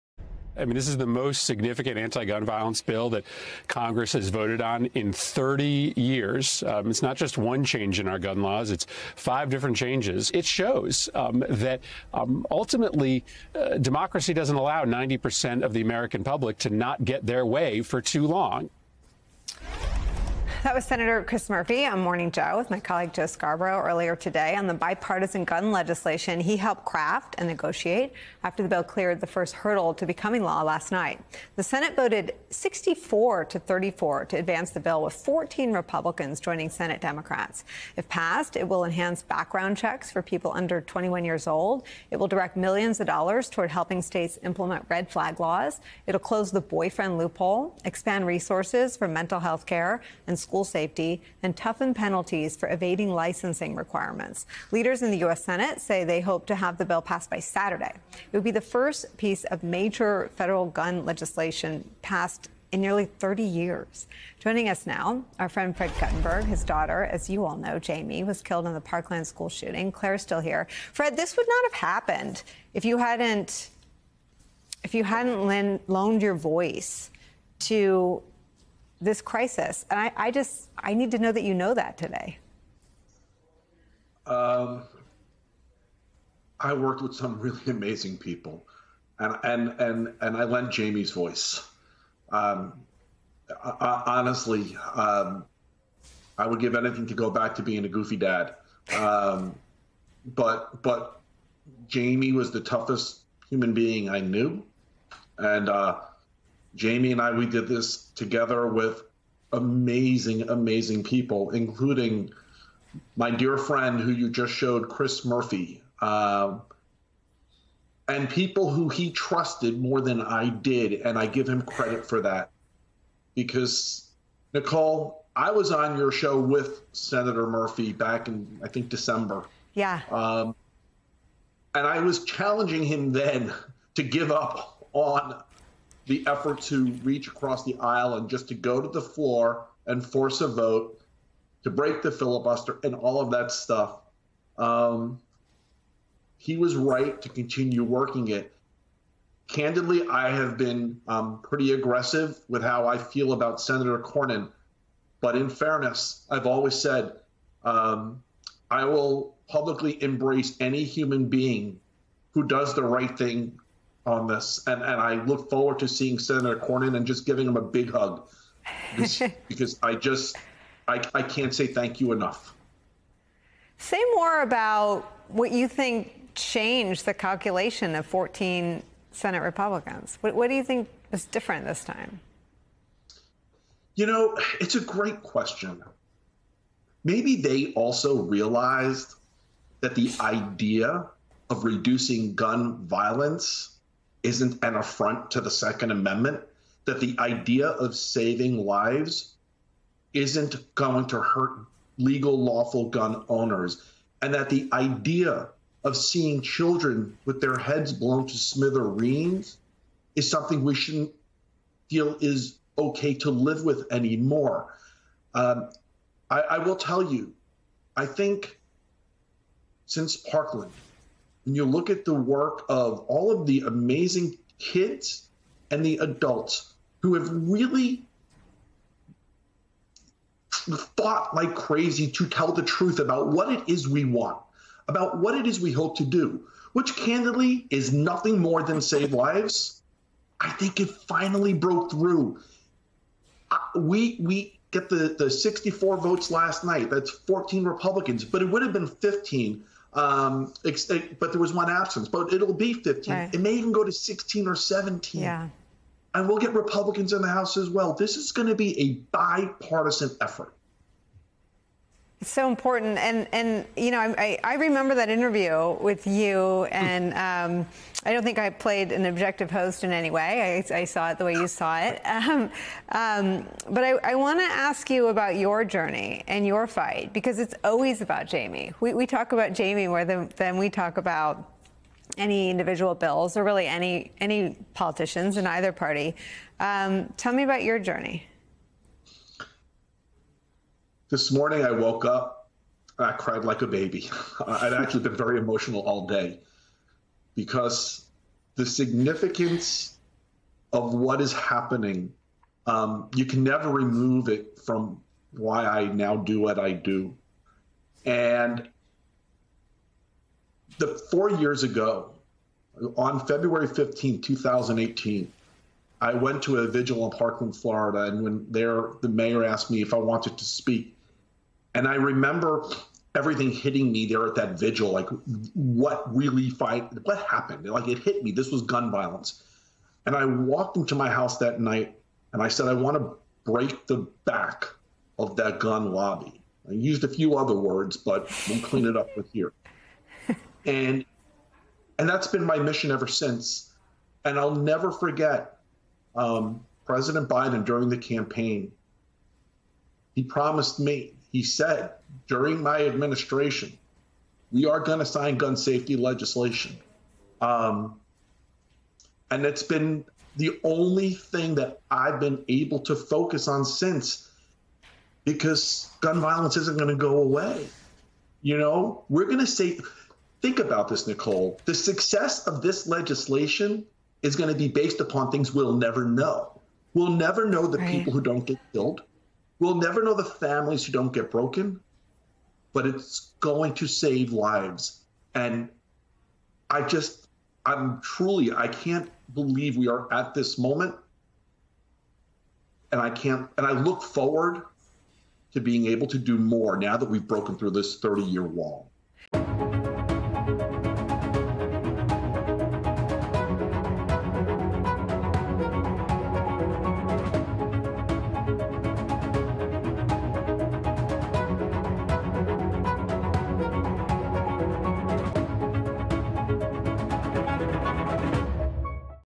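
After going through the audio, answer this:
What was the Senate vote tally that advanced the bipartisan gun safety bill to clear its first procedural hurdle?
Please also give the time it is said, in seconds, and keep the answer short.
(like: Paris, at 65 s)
64 to 34, at 32 s.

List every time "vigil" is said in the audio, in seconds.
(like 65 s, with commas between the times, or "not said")
316 s, 324 s.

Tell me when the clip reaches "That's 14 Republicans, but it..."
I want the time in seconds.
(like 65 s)
246 s.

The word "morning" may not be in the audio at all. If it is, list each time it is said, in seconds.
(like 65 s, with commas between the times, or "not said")
22 s, 291 s.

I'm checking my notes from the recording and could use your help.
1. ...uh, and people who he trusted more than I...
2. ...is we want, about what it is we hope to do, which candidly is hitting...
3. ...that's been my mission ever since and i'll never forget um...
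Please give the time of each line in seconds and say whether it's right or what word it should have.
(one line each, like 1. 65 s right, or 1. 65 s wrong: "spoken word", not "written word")
1. 116 s right
2. 233 s wrong: "nothing", not "hitting"
3. 342 s right.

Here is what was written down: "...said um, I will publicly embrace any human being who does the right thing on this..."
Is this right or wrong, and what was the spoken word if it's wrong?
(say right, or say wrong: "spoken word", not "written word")
right.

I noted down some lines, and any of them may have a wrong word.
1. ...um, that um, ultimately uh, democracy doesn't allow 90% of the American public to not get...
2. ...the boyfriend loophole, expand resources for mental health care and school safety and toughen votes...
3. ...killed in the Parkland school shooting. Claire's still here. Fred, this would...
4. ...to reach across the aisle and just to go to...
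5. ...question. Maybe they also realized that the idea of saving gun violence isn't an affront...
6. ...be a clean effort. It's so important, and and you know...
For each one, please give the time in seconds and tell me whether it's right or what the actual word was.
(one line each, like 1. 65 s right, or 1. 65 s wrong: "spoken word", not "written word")
1. 11 s right
2. 46 s wrong: "penalties", not "votes"
3. 68 s right
4. 136 s right
5. 185 s wrong: "reducing", not "saving"
6. 258 s wrong: "bipartisan", not "clean".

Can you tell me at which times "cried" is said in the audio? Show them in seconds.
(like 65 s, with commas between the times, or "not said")
293 s.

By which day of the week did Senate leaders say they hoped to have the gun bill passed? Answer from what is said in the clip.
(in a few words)
Saturday.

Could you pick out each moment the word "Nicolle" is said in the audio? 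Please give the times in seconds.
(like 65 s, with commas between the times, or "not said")
124 s, 371 s.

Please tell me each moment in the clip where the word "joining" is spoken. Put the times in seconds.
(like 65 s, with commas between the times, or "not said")
36 s, 64 s.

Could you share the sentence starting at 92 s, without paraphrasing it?
Um, I, honestly, um, I would give anything to go back to being a goofy dad.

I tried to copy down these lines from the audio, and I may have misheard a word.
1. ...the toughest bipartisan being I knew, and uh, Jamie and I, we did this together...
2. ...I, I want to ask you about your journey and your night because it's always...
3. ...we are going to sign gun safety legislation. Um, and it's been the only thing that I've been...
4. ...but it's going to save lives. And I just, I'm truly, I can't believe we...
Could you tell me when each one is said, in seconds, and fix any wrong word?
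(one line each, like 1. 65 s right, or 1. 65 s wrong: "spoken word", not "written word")
1. 102 s wrong: "human", not "bipartisan"
2. 273 s wrong: "fight", not "night"
3. 354 s right
4. 382 s right.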